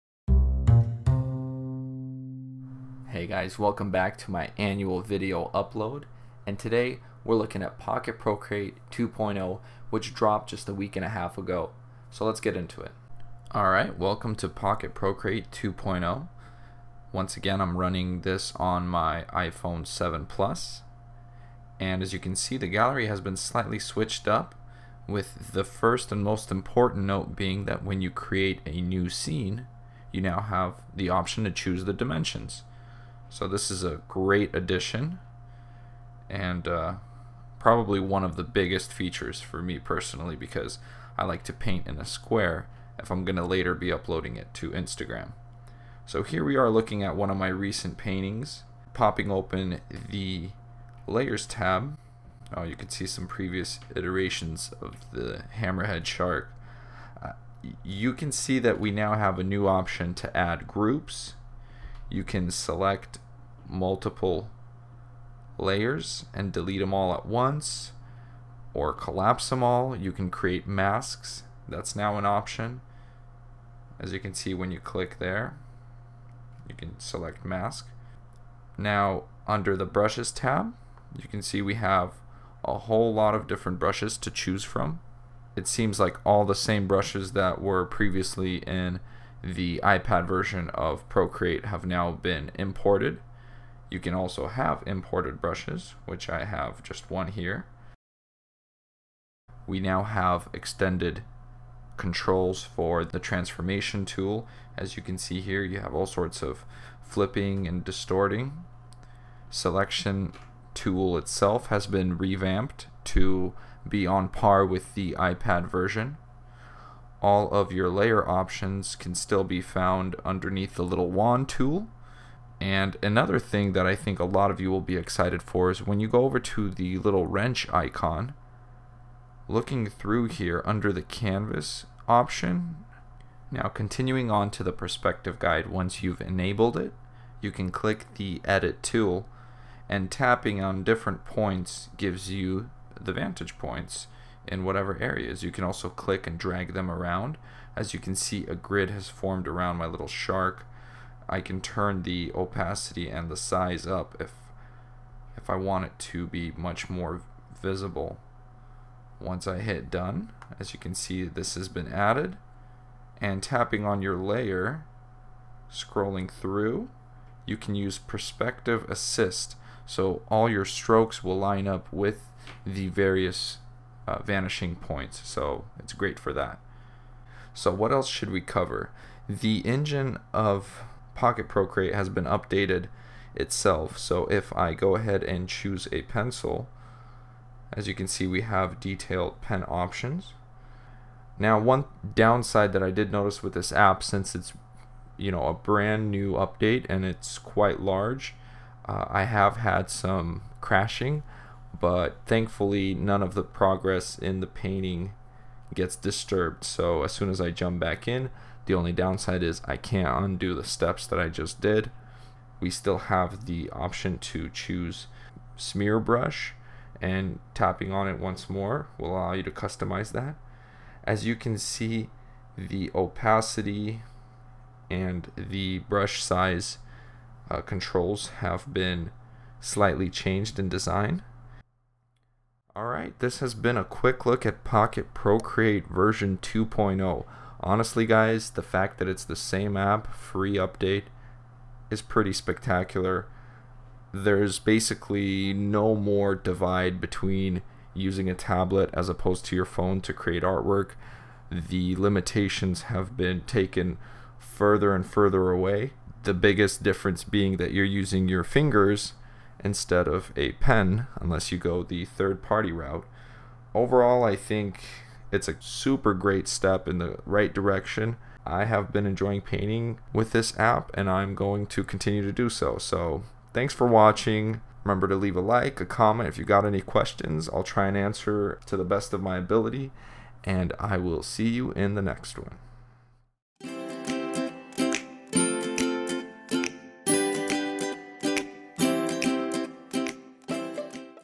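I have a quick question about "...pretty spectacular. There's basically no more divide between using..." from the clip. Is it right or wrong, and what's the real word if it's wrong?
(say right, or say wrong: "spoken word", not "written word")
right.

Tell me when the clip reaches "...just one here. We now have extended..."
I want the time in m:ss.
1:36.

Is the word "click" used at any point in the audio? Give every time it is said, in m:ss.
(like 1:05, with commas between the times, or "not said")
1:14, 2:17, 2:25.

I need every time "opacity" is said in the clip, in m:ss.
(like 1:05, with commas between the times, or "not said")
2:32, 3:42.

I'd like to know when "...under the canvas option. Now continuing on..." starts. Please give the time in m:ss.
2:10.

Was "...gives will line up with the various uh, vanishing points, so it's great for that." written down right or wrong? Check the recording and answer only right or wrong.
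wrong.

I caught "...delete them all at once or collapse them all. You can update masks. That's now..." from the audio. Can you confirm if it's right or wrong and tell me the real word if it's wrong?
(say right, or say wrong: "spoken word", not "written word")
wrong: "create", not "update".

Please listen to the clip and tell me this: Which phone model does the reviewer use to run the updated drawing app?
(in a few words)
iPhone 7 Plus.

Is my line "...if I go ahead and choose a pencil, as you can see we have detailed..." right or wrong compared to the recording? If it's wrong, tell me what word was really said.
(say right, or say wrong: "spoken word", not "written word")
right.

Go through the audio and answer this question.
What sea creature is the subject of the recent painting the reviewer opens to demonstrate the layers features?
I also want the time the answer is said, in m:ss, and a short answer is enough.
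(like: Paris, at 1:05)
Hammerhead Shark, at 0:55.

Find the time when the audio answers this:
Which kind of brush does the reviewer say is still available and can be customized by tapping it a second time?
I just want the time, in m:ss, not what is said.
3:35.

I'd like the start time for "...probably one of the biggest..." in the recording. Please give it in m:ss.
0:37.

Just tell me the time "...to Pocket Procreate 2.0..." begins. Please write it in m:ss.
0:14.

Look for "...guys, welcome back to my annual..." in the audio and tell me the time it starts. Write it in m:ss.
0:03.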